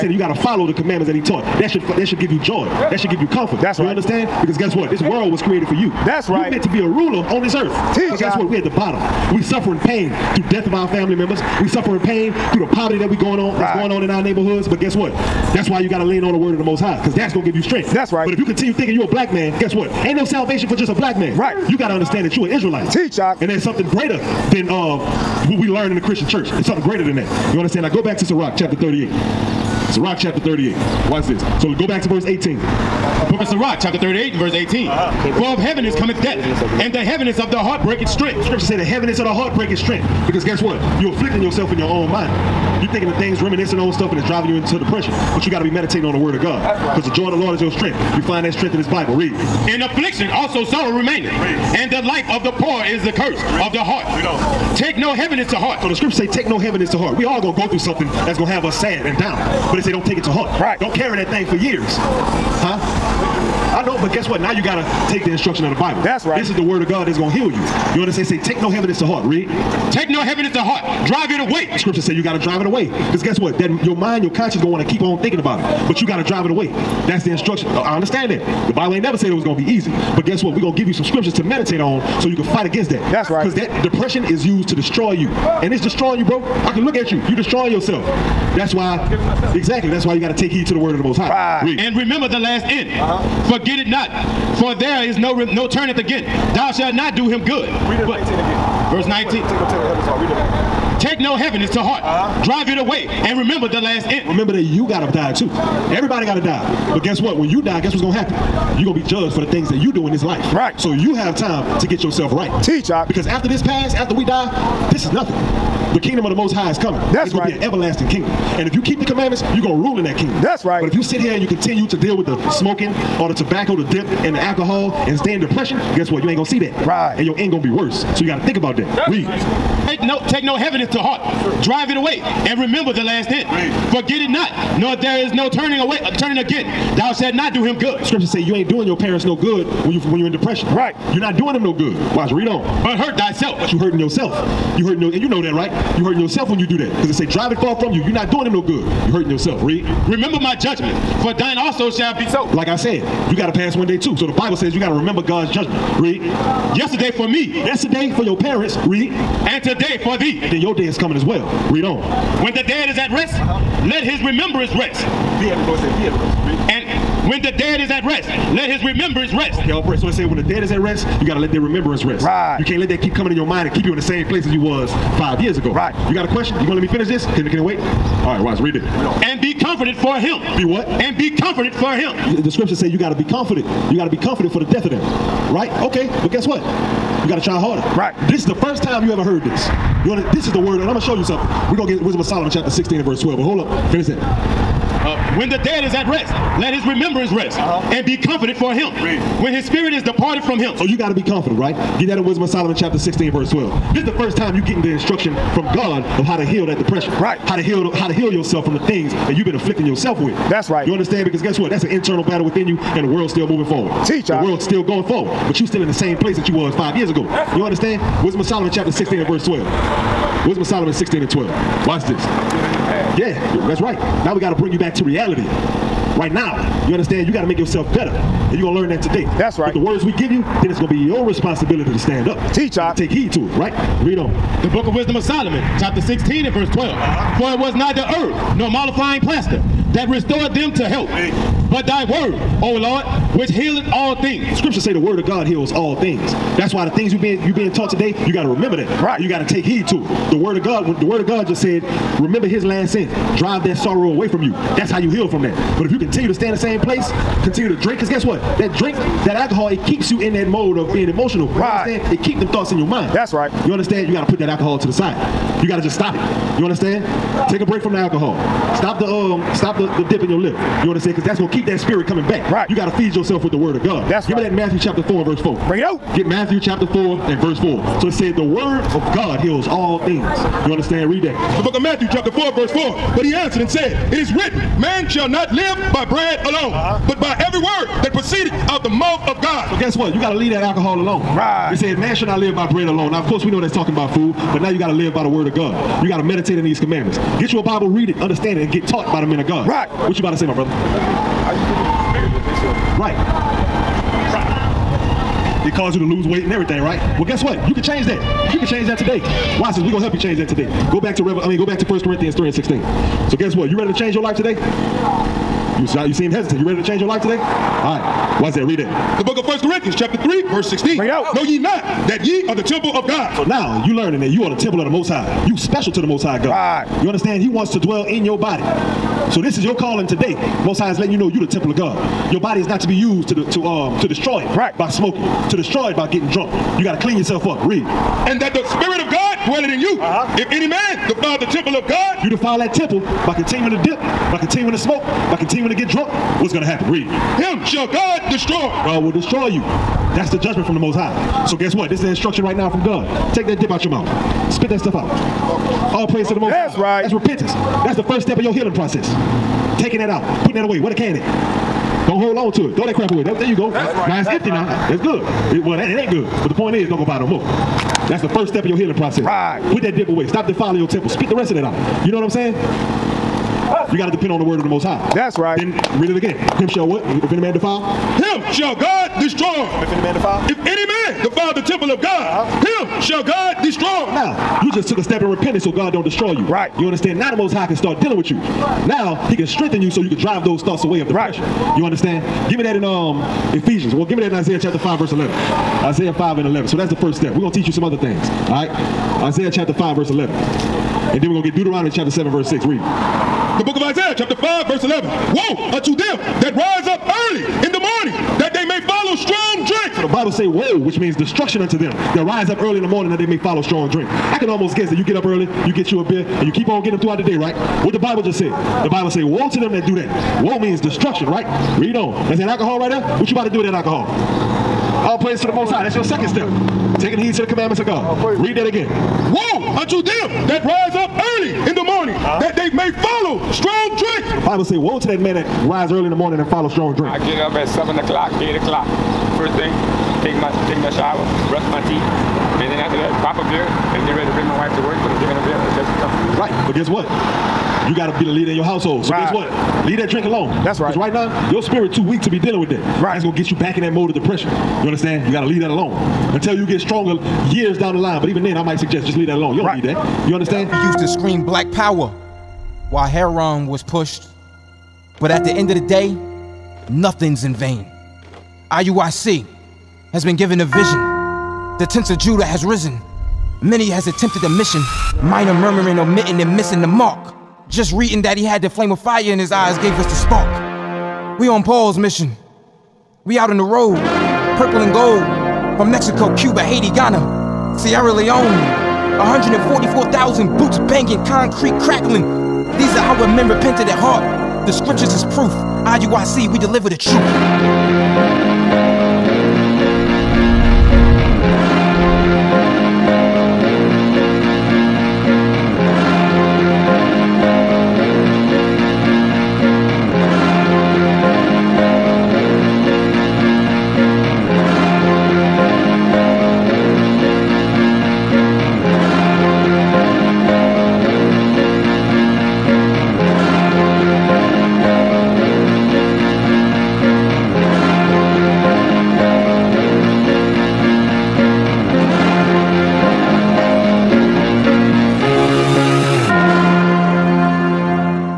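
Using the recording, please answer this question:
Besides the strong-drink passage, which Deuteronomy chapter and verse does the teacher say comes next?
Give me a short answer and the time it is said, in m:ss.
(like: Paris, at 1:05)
Deuteronomy 7:6, at 6:41.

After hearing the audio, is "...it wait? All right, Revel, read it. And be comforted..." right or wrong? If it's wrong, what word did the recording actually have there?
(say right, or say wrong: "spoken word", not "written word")
wrong: "Ross", not "Revel".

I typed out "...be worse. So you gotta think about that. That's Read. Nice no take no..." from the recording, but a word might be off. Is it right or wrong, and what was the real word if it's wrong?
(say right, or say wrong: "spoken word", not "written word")
right.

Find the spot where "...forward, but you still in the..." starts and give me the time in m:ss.
3:35.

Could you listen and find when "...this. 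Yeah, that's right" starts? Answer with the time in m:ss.
3:42.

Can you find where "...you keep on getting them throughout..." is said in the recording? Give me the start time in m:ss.
6:56.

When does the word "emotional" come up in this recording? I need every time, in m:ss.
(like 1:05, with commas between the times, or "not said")
4:21.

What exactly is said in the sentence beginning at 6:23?
Now, you just took a step in repentance so God don't destroy you.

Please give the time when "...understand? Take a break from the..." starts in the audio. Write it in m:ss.
4:26.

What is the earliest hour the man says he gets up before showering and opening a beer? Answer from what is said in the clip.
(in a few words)
7 o'clock.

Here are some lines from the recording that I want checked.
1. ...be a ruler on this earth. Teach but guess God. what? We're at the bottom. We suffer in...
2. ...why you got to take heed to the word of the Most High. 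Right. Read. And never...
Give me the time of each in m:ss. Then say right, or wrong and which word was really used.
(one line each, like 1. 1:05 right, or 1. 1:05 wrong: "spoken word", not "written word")
1. 0:06 right
2. 1:30 wrong: "remember", not "never".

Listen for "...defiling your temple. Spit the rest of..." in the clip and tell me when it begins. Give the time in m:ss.
6:10.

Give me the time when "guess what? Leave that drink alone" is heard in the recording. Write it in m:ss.
7:29.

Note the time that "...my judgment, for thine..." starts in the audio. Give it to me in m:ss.
2:30.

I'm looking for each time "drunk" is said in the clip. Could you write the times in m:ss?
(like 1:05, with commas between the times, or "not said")
5:36, 5:45.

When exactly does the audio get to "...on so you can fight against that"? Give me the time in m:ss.
1:21.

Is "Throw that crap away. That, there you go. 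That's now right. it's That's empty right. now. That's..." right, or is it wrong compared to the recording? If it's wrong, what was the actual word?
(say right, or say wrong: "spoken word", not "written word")
right.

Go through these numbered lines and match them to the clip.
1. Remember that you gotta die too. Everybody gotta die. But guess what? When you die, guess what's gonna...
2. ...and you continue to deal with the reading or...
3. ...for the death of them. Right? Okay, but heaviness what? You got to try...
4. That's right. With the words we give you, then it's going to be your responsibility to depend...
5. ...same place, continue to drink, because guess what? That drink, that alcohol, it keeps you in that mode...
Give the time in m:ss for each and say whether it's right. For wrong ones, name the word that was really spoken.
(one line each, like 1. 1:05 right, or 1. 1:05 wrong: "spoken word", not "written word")
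1. 1:44 right
2. 2:01 wrong: "smoking", not "reading"
3. 3:04 wrong: "guess", not "heaviness"
4. 3:49 wrong: "stand", not "depend"
5. 4:16 right.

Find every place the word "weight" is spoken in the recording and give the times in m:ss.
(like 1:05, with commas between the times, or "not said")
5:06.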